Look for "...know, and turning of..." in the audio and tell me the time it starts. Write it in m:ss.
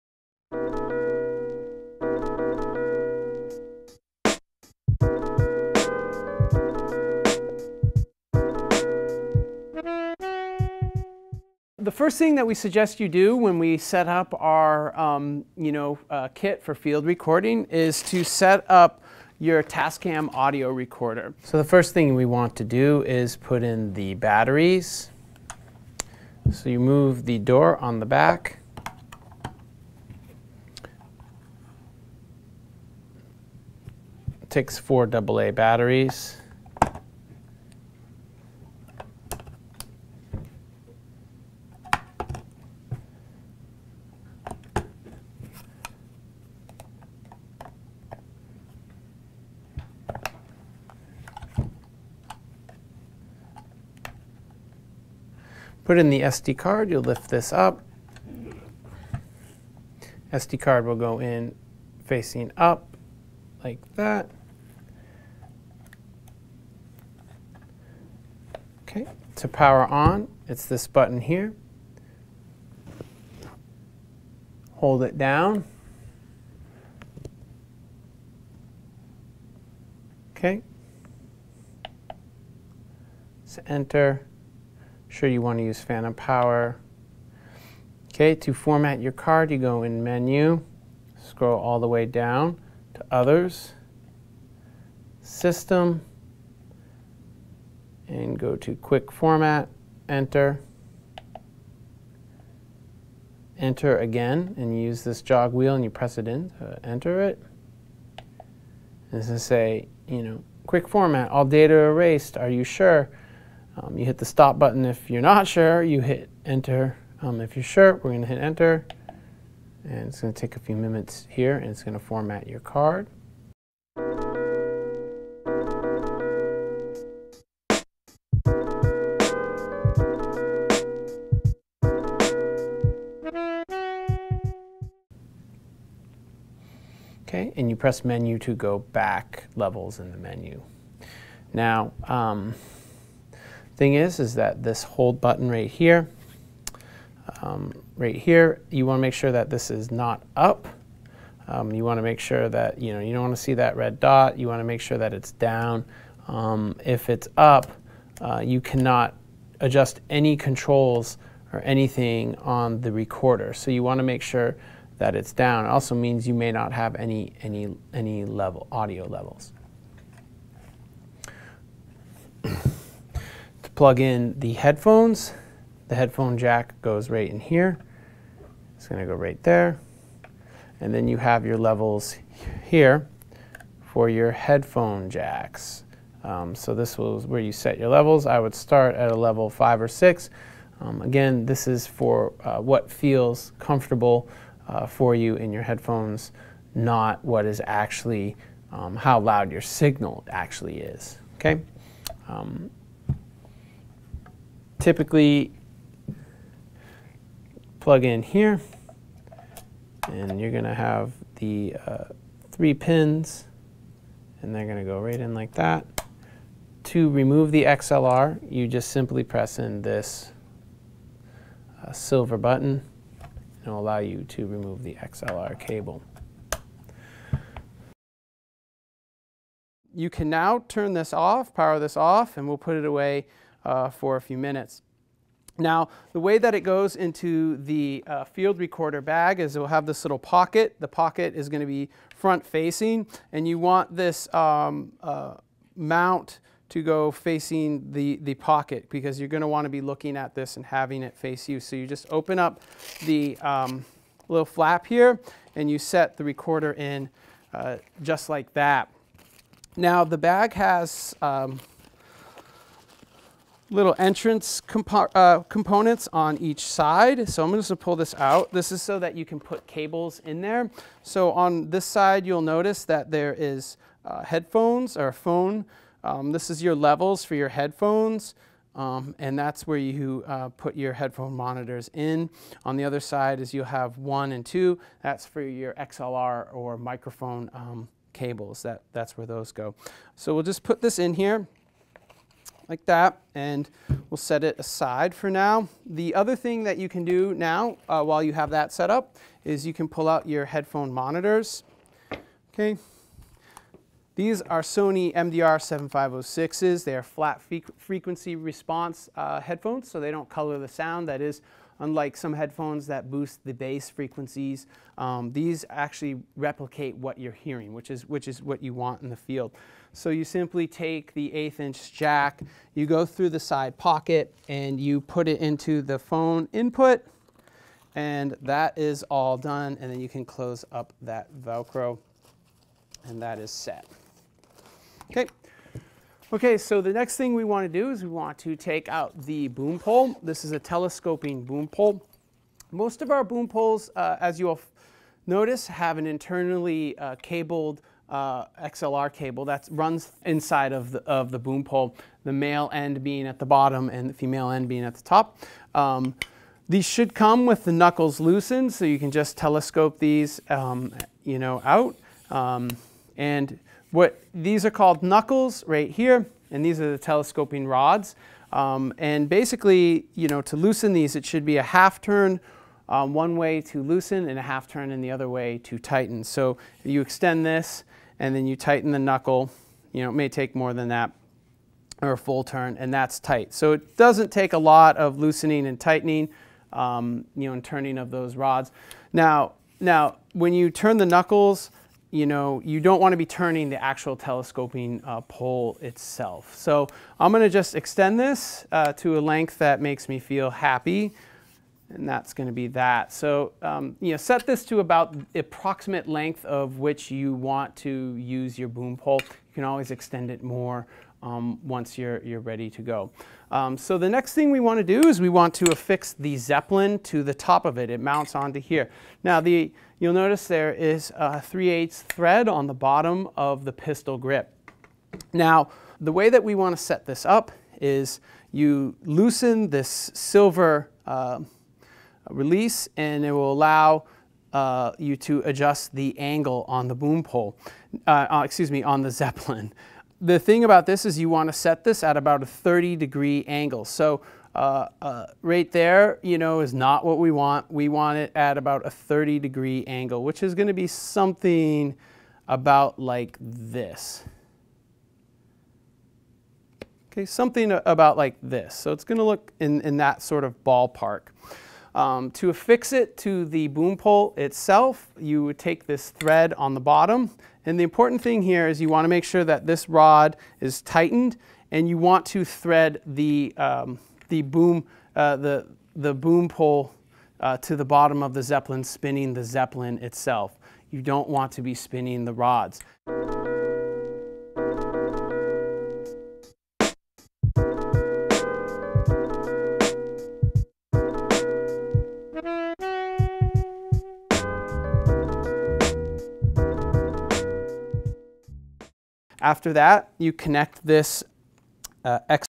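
6:27.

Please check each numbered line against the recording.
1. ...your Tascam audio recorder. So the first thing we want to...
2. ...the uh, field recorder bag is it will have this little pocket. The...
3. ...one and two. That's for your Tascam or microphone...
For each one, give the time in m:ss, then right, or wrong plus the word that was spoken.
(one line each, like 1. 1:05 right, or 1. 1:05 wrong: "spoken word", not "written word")
1. 0:19 right
2. 3:57 right
3. 4:43 wrong: "XLR", not "Tascam".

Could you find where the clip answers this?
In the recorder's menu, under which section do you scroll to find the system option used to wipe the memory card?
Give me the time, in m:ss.
1:33.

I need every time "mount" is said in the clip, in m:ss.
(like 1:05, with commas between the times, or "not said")
4:05, 6:57.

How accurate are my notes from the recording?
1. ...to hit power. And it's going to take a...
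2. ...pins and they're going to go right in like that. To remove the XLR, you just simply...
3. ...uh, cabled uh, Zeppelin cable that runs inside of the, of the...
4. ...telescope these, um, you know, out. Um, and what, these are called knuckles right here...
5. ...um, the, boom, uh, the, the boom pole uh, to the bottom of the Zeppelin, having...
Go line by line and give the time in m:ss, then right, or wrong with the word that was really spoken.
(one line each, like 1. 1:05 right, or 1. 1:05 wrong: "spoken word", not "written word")
1. 1:58 wrong: "enter", not "power"
2. 3:32 right
3. 5:46 wrong: "XLR", not "Zeppelin"
4. 5:59 right
5. 7:53 wrong: "spinning", not "having".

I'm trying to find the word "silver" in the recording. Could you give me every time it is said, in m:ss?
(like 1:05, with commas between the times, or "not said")
3:41, 7:10.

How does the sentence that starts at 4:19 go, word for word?
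Now the bag has um, little entrance compo uh, components on each side.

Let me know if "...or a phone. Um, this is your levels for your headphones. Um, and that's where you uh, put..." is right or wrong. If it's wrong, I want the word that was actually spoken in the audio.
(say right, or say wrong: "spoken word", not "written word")
right.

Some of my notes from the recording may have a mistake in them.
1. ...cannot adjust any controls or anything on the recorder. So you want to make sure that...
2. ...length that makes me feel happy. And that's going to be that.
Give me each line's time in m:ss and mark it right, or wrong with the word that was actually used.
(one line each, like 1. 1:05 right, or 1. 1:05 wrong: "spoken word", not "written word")
1. 2:38 right
2. 6:39 right.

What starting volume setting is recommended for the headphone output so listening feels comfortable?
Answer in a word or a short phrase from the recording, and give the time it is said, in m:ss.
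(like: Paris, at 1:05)
5 or 6, at 3:09.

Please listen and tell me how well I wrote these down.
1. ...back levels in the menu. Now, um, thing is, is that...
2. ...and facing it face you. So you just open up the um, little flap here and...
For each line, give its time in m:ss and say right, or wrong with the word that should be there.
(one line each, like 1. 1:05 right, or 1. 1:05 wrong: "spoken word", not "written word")
1. 2:18 right
2. 4:10 wrong: "having", not "facing".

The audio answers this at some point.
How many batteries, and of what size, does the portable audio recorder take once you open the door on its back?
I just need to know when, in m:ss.
0:34.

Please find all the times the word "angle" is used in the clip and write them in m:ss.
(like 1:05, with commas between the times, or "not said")
7:16, 7:23, 7:29.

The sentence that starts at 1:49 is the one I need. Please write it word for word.
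This is say, you know, quick format, all data erased, are you sure?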